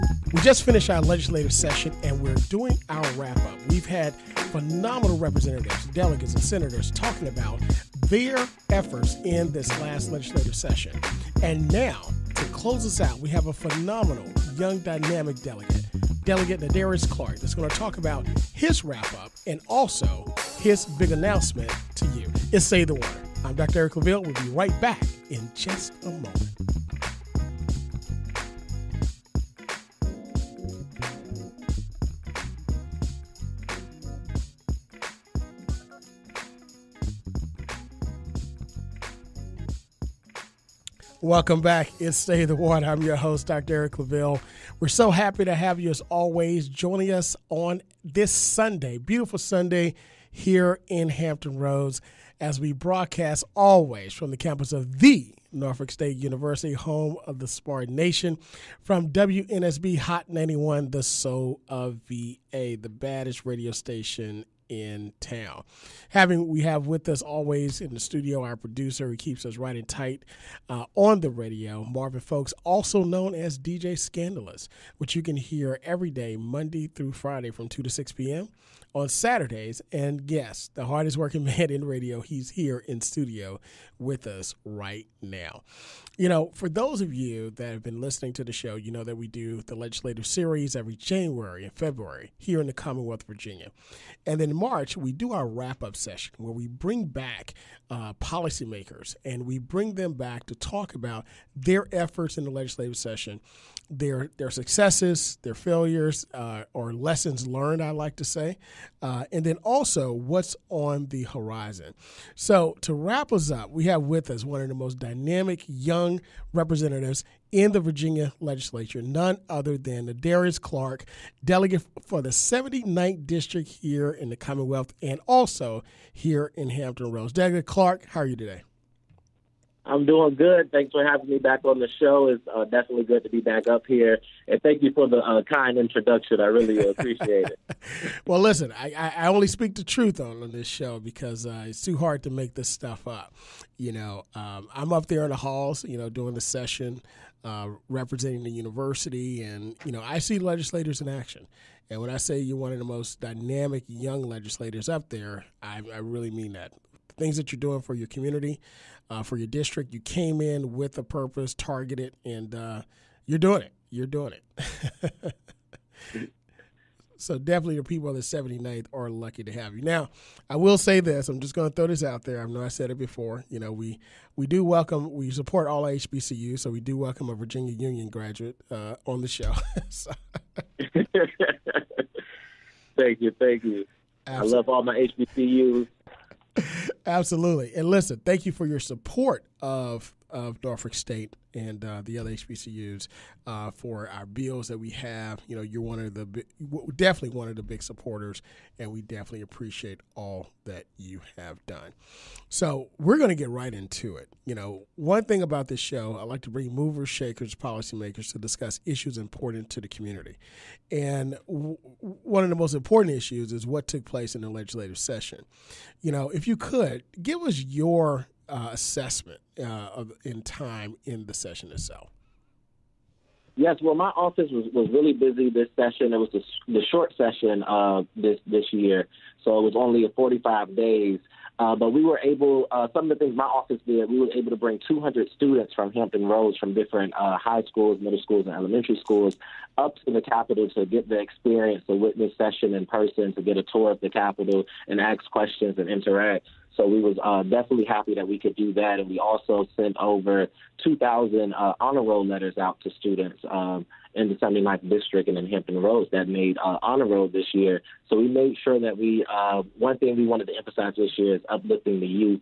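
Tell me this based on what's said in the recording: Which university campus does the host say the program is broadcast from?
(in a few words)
Norfolk State University.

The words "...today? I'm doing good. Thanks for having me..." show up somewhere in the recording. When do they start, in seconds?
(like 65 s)
128 s.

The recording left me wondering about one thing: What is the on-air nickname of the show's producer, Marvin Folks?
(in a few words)
DJ Scandalous.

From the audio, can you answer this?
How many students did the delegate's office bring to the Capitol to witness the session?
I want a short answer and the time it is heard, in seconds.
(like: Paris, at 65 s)
200, at 234 s.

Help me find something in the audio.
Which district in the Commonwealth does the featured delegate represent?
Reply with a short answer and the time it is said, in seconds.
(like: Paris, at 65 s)
79th, at 122 s.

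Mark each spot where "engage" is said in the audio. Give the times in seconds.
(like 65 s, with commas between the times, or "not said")
not said.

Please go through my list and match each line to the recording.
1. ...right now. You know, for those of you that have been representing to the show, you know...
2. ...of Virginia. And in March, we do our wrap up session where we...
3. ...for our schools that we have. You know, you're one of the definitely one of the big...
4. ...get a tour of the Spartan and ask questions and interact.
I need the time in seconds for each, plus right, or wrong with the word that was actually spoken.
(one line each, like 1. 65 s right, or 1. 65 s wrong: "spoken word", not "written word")
1. 84 s wrong: "listening", not "representing"
2. 93 s right
3. 193 s wrong: "bills", not "schools"
4. 243 s wrong: "Capitol", not "Spartan".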